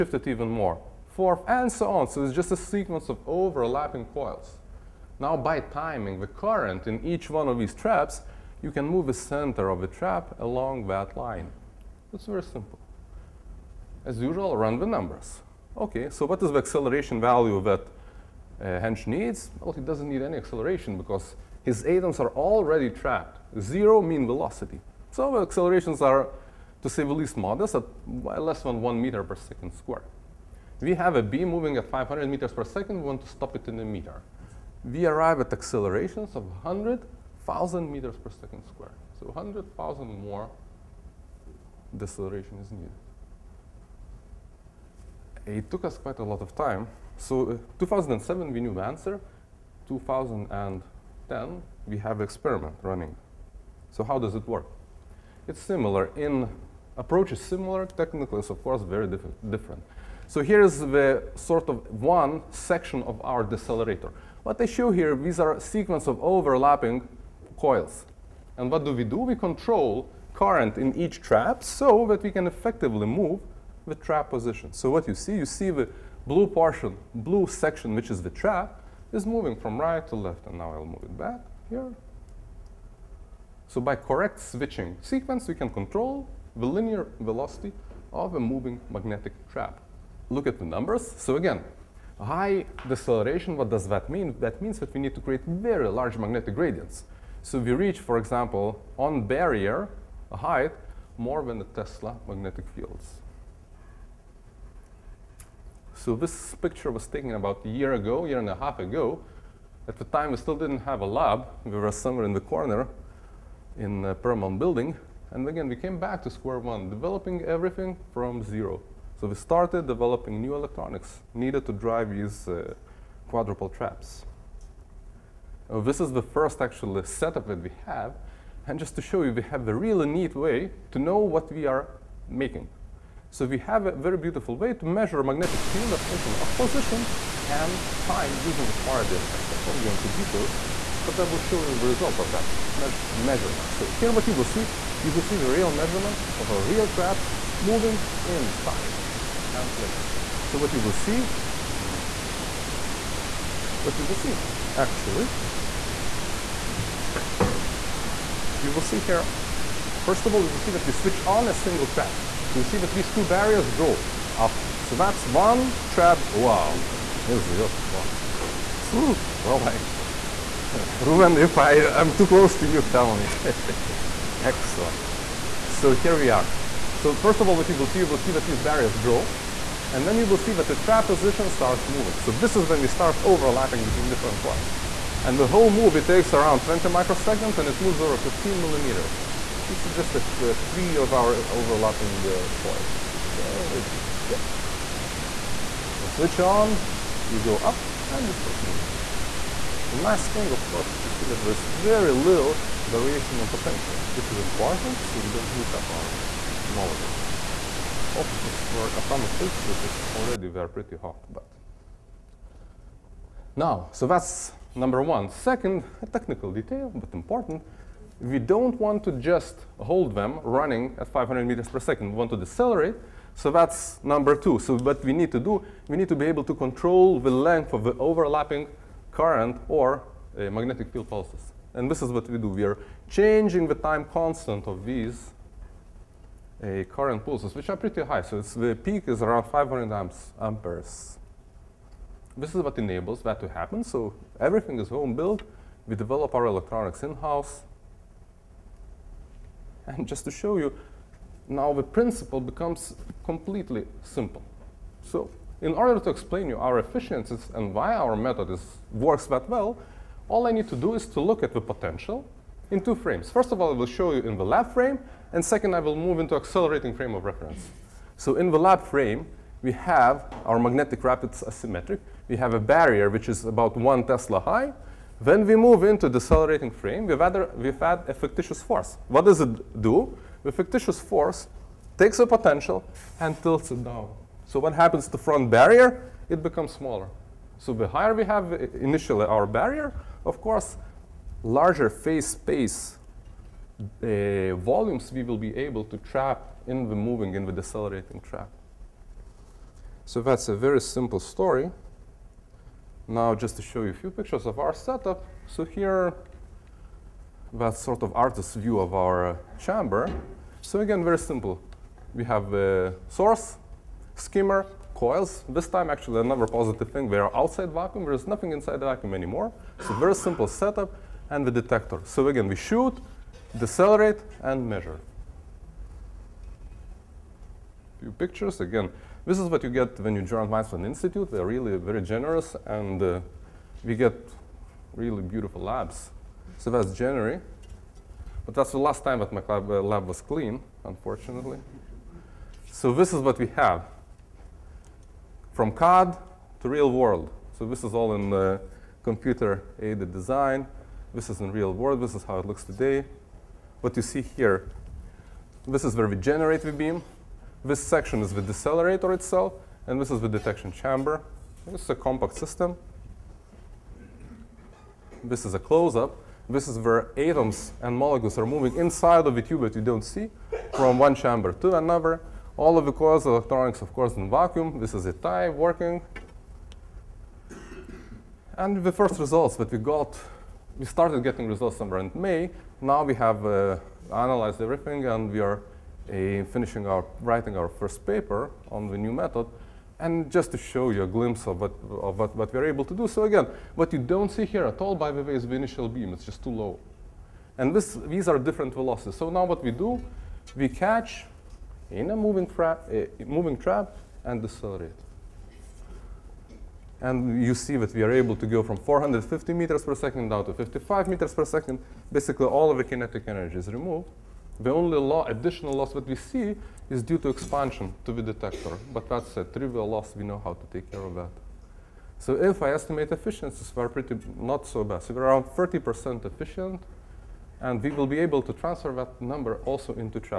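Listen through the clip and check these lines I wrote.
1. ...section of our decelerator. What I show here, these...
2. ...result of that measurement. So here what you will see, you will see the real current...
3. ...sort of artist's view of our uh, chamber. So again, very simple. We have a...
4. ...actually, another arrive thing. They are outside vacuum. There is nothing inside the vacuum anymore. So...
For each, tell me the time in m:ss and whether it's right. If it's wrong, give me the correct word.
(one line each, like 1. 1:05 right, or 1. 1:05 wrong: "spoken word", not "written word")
1. 1:02 right
2. 2:21 wrong: "measurement", not "current"
3. 5:07 right
4. 5:15 wrong: "positive", not "arrive".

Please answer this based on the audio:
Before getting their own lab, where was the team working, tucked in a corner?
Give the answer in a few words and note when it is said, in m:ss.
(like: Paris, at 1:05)
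the Paramount building, at 1:54.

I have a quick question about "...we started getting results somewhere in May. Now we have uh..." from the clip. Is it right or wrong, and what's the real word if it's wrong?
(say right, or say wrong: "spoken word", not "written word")
right.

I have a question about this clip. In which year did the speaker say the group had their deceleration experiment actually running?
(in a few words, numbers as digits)
2010.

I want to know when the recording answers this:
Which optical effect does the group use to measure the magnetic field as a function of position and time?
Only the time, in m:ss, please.
2:18.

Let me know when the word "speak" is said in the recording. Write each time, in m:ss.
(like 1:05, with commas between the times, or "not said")
not said.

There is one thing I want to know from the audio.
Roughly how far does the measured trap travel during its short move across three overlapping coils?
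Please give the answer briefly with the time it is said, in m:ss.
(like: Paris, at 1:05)
15 millimeters, at 3:08.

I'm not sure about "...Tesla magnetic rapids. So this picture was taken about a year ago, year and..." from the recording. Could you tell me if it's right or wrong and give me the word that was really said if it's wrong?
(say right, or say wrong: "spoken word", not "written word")
wrong: "fields", not "rapids".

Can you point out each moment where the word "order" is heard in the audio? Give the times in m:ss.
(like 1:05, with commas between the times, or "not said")
4:15.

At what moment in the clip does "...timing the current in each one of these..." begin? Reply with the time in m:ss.
0:05.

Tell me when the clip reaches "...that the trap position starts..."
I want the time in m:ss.
3:00.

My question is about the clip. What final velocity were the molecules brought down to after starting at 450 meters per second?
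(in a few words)
55 meters per second.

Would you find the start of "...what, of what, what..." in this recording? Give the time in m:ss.
6:31.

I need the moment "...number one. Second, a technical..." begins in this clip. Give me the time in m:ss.
3:34.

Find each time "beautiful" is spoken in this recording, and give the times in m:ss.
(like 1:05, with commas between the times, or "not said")
2:14, 5:35.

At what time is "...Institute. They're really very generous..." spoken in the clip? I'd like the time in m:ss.
5:30.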